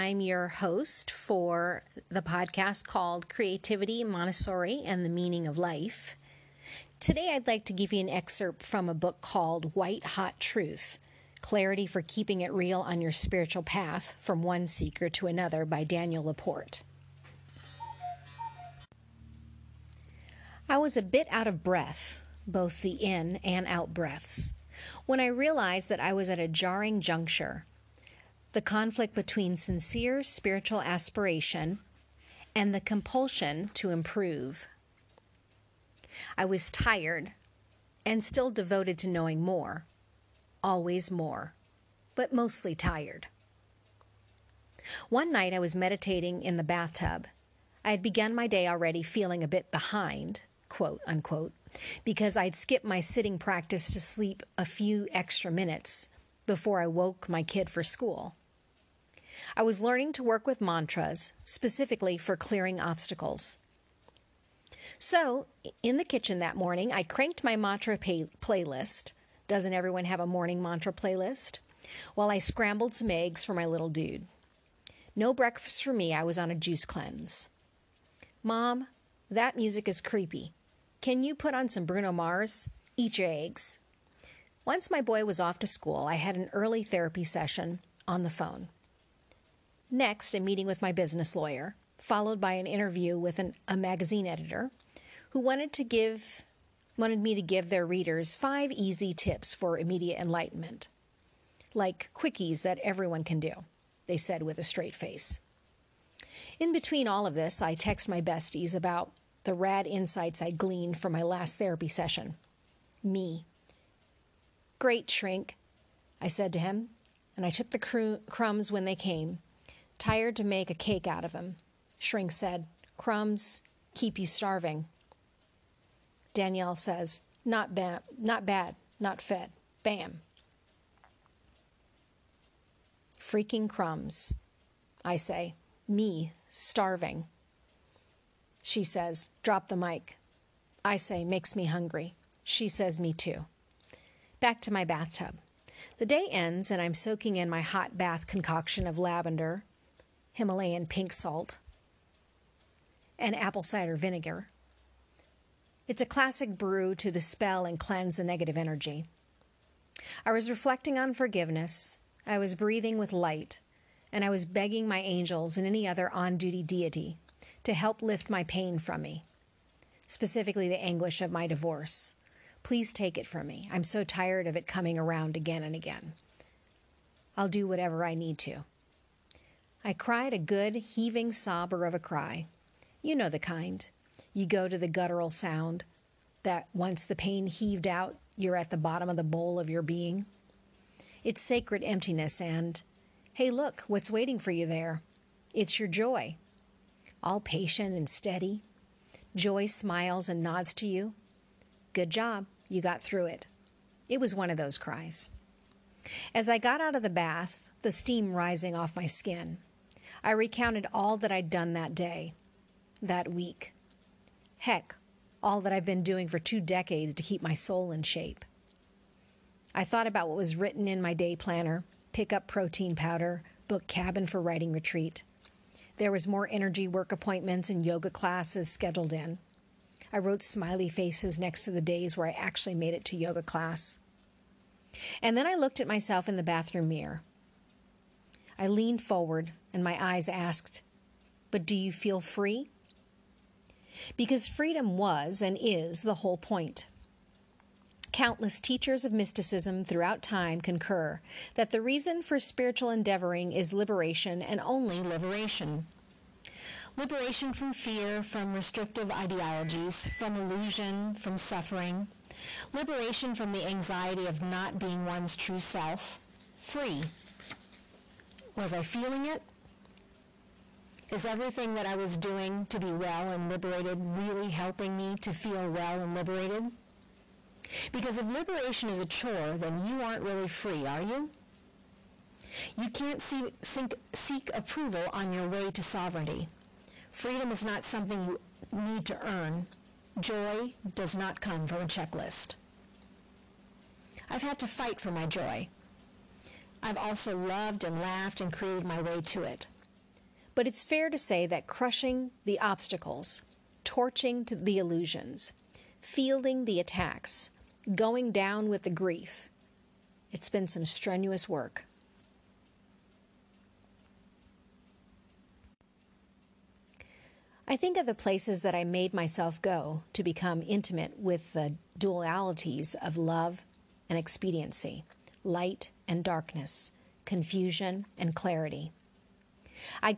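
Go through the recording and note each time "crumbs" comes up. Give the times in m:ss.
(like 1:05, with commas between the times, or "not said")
1:58, 2:02, 2:13.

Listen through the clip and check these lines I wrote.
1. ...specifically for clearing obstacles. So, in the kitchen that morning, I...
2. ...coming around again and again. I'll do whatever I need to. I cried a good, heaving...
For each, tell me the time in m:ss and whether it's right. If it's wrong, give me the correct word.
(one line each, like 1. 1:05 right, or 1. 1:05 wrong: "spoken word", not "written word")
1. 1:01 right
2. 2:54 right.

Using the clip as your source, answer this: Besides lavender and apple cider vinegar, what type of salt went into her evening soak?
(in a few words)
Himalayan pink salt.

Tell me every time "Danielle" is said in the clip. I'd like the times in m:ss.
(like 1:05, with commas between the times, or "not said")
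0:15, 2:06.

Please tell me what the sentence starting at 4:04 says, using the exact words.
Because freedom was and is the whole point.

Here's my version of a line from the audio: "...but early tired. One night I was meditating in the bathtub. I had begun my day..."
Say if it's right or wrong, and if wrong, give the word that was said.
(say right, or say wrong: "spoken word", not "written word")
wrong: "mostly", not "early".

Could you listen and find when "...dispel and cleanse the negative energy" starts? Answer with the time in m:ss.
2:37.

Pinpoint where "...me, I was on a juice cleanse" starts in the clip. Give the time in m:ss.
1:15.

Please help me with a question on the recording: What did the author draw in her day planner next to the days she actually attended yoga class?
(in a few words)
smiley faces.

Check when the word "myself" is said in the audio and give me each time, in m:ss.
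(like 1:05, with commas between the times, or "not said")
3:55, 5:19.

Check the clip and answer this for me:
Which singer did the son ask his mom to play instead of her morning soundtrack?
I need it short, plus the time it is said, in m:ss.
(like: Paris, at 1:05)
Bruno Mars, at 1:21.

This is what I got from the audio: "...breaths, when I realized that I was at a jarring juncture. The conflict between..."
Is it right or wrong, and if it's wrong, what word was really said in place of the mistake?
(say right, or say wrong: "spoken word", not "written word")
right.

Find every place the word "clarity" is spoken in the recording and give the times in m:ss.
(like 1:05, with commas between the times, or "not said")
0:11, 5:28.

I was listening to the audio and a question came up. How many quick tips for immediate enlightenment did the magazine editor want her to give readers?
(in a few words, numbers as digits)
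5.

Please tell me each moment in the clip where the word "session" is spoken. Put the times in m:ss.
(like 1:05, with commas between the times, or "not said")
1:27, 1:51.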